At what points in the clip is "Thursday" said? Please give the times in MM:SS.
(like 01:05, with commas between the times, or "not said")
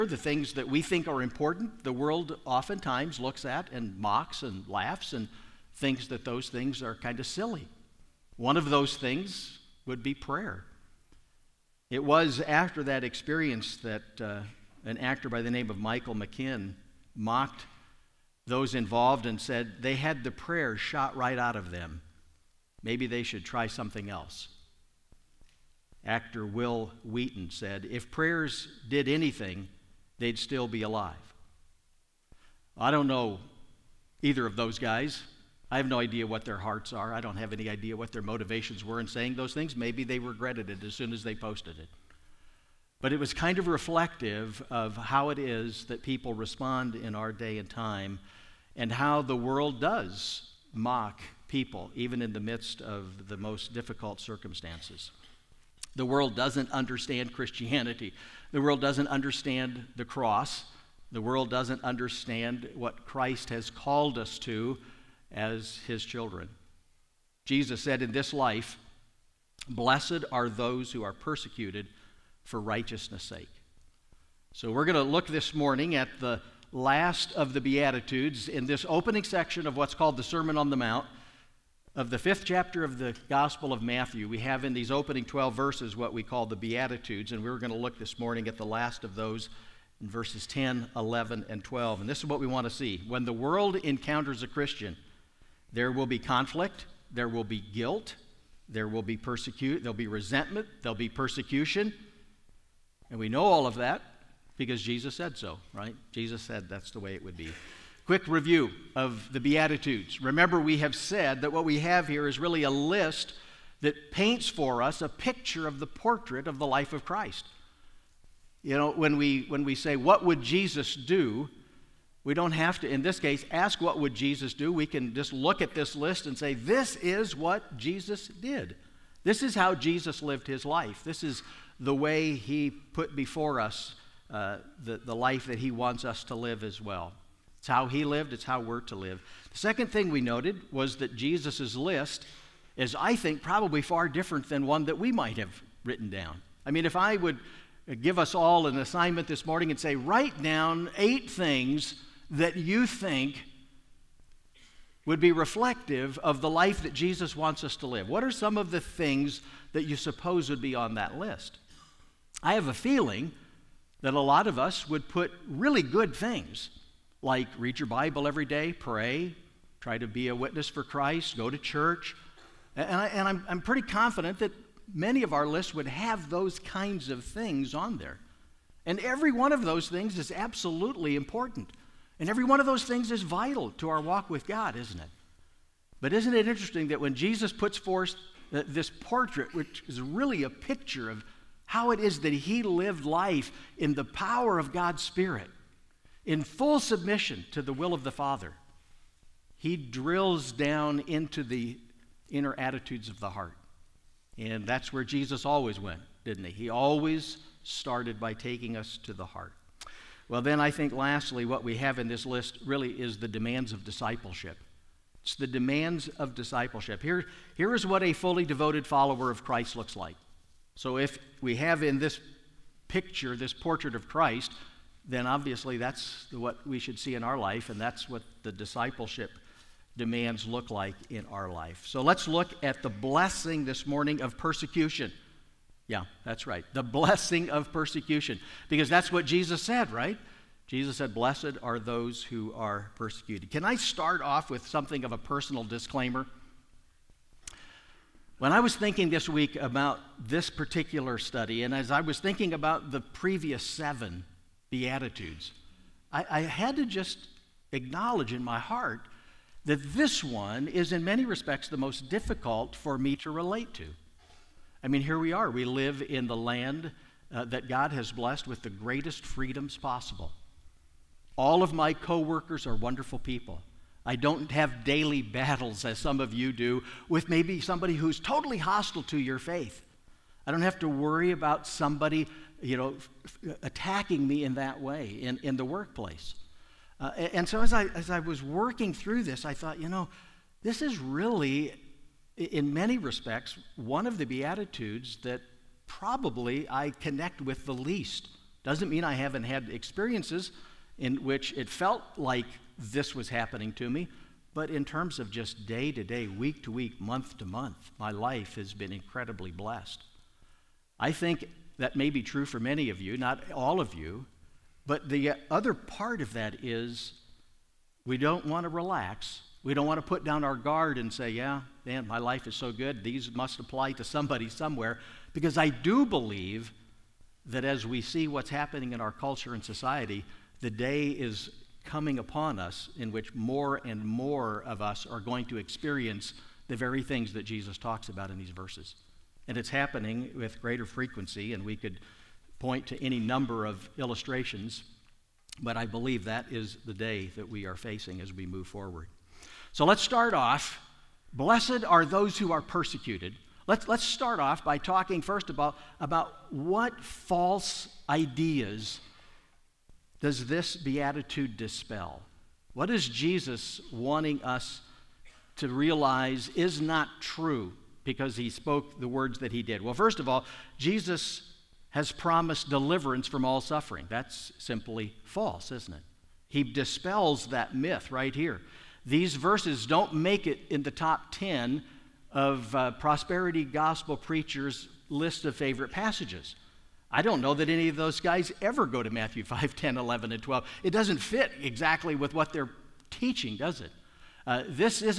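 not said.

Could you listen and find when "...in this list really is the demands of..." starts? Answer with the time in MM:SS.
03:31.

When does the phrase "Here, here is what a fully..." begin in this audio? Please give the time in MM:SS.
03:37.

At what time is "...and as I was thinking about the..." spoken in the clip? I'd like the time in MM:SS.
04:11.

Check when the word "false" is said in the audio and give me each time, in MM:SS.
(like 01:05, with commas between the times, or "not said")
05:57, 06:15.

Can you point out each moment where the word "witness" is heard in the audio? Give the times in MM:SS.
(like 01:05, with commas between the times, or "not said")
02:50.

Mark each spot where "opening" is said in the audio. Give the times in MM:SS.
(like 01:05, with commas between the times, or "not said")
01:18, 01:24.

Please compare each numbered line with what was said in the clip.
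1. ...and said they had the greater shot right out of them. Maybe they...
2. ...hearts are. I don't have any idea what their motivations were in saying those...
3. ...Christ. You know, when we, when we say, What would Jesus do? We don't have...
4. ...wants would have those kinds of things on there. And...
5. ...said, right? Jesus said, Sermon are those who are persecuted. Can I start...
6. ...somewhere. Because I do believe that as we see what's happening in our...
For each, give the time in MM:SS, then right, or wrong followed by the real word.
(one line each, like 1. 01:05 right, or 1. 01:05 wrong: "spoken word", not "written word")
1. 00:19 wrong: "prayer", not "greater"
2. 00:36 right
3. 01:57 right
4. 02:55 wrong: "lists", not "wants"
5. 03:59 wrong: "Blessed", not "Sermon"
6. 05:24 right.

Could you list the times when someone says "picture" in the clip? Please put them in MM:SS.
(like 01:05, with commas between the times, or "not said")
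01:55, 03:10, 03:42.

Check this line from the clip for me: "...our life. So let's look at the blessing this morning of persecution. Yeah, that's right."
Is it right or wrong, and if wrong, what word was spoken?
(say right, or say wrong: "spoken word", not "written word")
right.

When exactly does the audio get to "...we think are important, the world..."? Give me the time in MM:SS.
00:00.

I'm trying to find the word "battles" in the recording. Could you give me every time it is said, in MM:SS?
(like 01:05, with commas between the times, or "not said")
04:35.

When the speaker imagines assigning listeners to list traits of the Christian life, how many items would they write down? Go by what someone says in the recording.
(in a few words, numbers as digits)
8.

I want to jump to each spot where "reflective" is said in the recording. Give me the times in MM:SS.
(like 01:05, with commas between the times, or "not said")
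00:43, 02:35.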